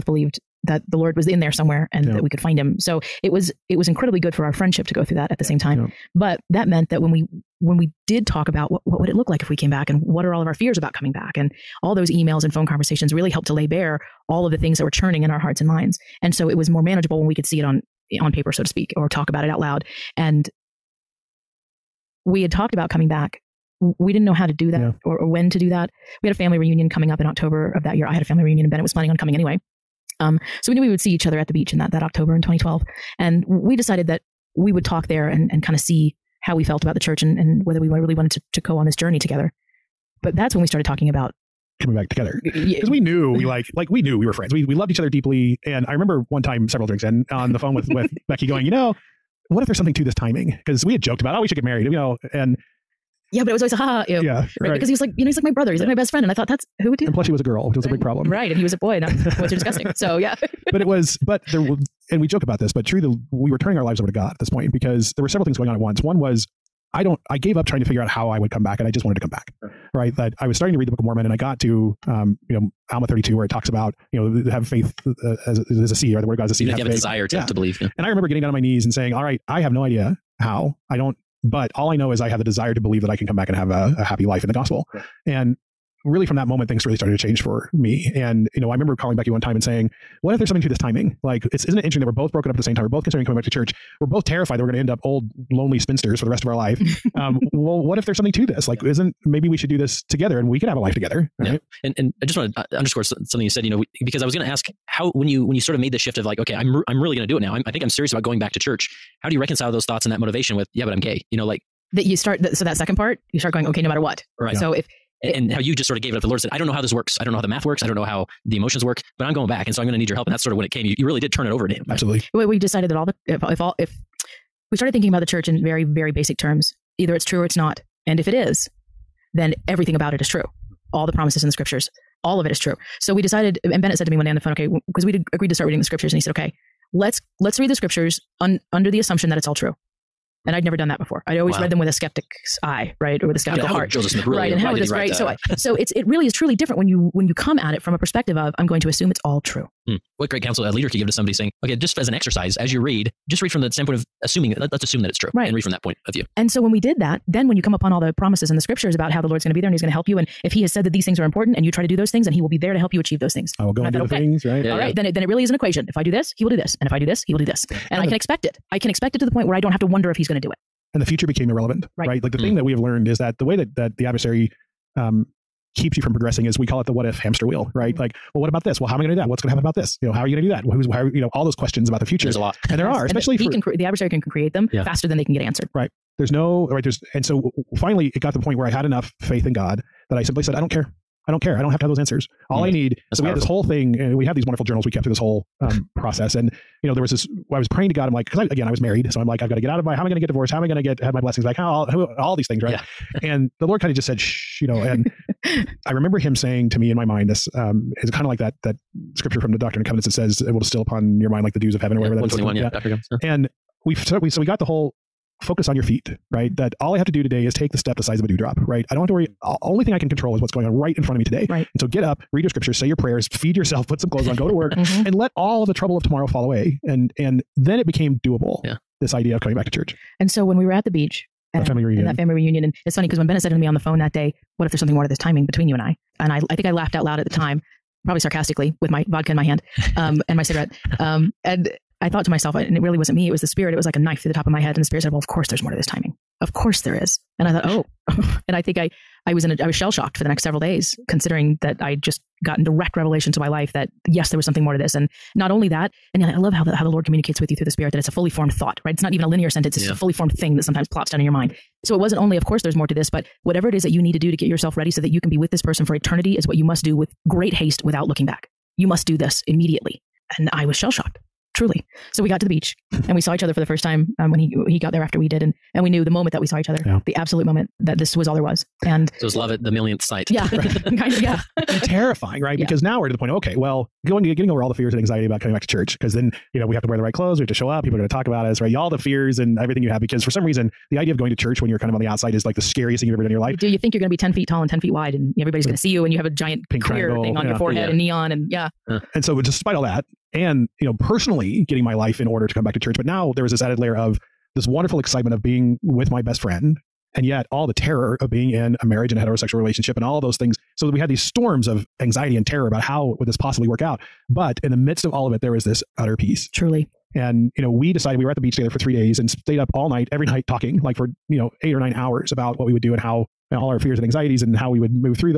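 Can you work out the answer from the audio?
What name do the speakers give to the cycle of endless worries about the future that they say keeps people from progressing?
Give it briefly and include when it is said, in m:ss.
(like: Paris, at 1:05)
what if hamster wheel, at 2:56.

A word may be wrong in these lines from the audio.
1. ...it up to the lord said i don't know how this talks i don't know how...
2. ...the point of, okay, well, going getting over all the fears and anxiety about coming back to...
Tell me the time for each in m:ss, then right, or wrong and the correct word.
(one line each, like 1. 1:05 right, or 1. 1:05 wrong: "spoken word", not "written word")
1. 1:56 wrong: "works", not "talks"
2. 4:43 right.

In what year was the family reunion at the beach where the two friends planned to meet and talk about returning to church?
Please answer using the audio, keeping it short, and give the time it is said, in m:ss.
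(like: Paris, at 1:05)
2012, at 0:32.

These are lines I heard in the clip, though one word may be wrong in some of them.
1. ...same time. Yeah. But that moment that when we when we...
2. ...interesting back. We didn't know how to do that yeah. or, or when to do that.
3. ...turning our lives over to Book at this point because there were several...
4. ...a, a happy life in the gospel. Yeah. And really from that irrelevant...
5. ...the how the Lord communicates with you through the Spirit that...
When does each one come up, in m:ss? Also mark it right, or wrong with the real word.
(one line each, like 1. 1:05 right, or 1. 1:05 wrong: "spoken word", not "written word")
1. 0:05 wrong: "meant", not "moment"
2. 0:22 wrong: "coming", not "interesting"
3. 1:03 wrong: "God", not "Book"
4. 1:23 wrong: "moment", not "irrelevant"
5. 4:16 right.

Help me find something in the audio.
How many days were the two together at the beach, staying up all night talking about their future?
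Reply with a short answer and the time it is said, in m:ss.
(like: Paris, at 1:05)
3, at 5:18.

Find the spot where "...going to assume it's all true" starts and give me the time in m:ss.
2:28.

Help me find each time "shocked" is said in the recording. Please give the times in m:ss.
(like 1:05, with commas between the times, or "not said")
4:09, 4:30.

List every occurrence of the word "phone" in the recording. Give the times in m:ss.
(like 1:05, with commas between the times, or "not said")
0:12, 0:47, 2:14, 3:53.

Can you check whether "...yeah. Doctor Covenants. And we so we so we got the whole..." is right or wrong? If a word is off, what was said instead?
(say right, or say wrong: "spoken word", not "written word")
right.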